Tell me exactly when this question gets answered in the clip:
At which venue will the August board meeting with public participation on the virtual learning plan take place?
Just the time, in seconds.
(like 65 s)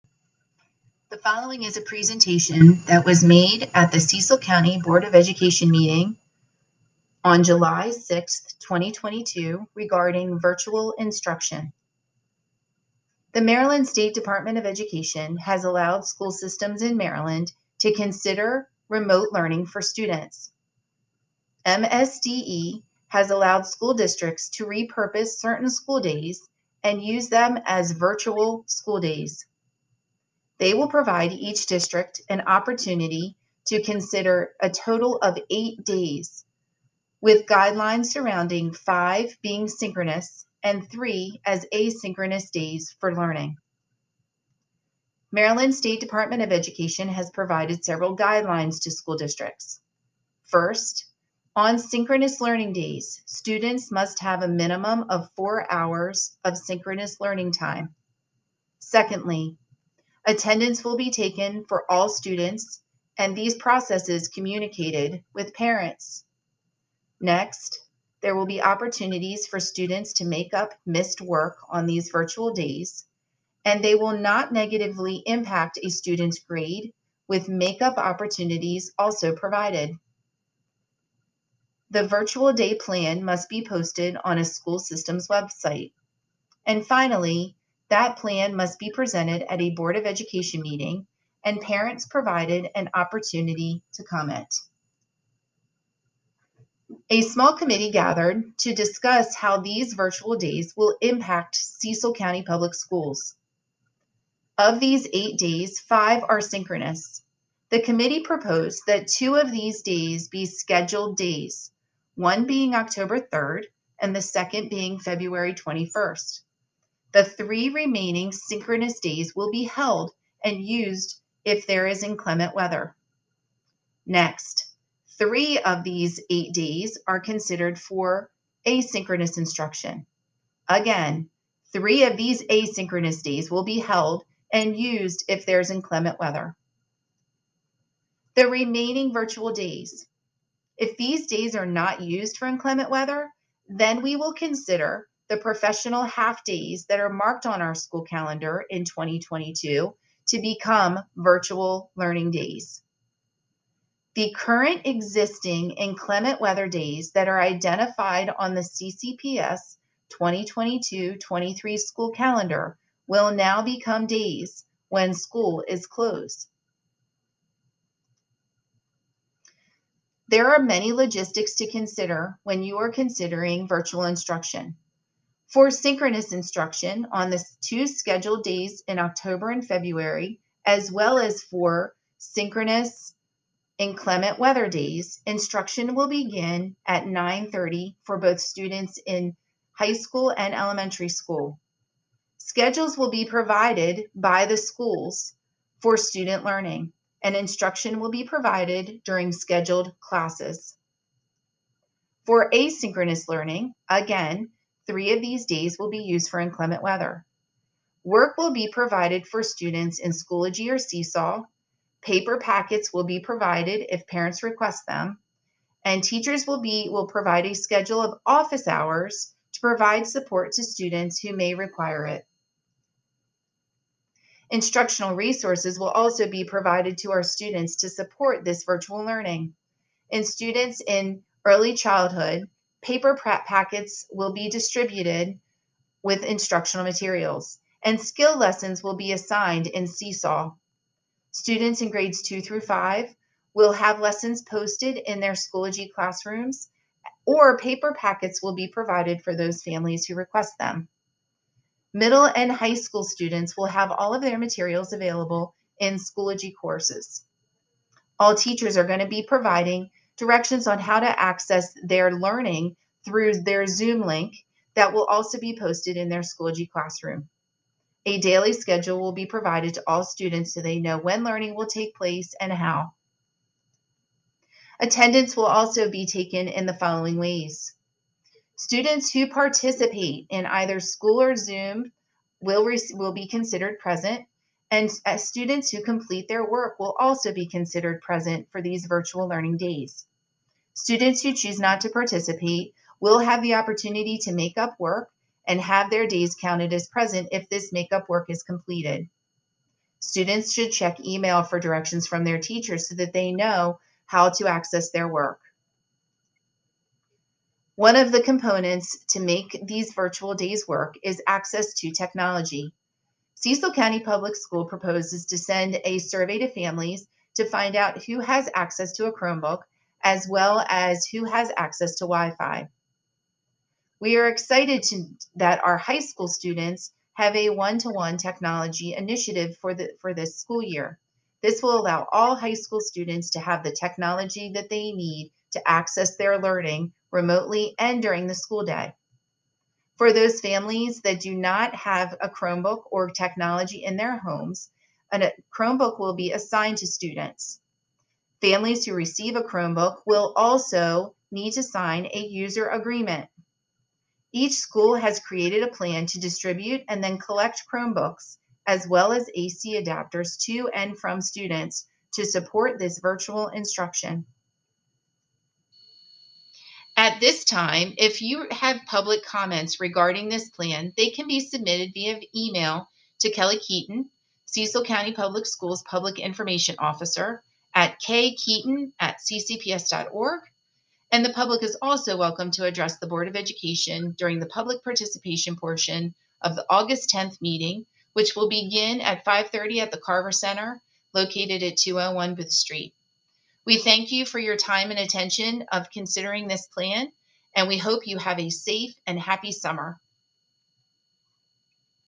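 389 s.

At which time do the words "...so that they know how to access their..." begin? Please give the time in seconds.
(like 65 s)
302 s.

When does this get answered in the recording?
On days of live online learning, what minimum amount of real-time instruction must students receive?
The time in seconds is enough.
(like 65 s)
55 s.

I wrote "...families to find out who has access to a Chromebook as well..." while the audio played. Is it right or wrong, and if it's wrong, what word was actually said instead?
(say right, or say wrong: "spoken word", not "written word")
right.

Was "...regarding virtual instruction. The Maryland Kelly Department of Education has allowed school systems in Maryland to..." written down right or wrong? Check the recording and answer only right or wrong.
wrong.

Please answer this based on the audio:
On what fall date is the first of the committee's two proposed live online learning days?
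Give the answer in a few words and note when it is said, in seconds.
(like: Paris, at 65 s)
October 3, at 112 s.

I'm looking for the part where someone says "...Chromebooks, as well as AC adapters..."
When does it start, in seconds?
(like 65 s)
357 s.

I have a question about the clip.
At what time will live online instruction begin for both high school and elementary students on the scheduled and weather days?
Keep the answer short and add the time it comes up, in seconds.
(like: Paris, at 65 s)
9:30, at 187 s.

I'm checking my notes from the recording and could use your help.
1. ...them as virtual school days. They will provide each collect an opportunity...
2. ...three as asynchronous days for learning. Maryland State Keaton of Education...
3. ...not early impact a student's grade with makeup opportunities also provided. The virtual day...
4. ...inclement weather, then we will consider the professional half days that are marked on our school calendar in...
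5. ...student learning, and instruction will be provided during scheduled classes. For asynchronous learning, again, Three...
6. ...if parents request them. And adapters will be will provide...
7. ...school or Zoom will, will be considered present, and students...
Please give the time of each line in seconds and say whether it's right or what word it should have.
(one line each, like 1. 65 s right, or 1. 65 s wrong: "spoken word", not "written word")
1. 27 s wrong: "district", not "collect"
2. 40 s wrong: "Department", not "Keaton"
3. 74 s wrong: "negatively", not "early"
4. 142 s right
5. 195 s right
6. 213 s wrong: "teachers", not "adapters"
7. 280 s right.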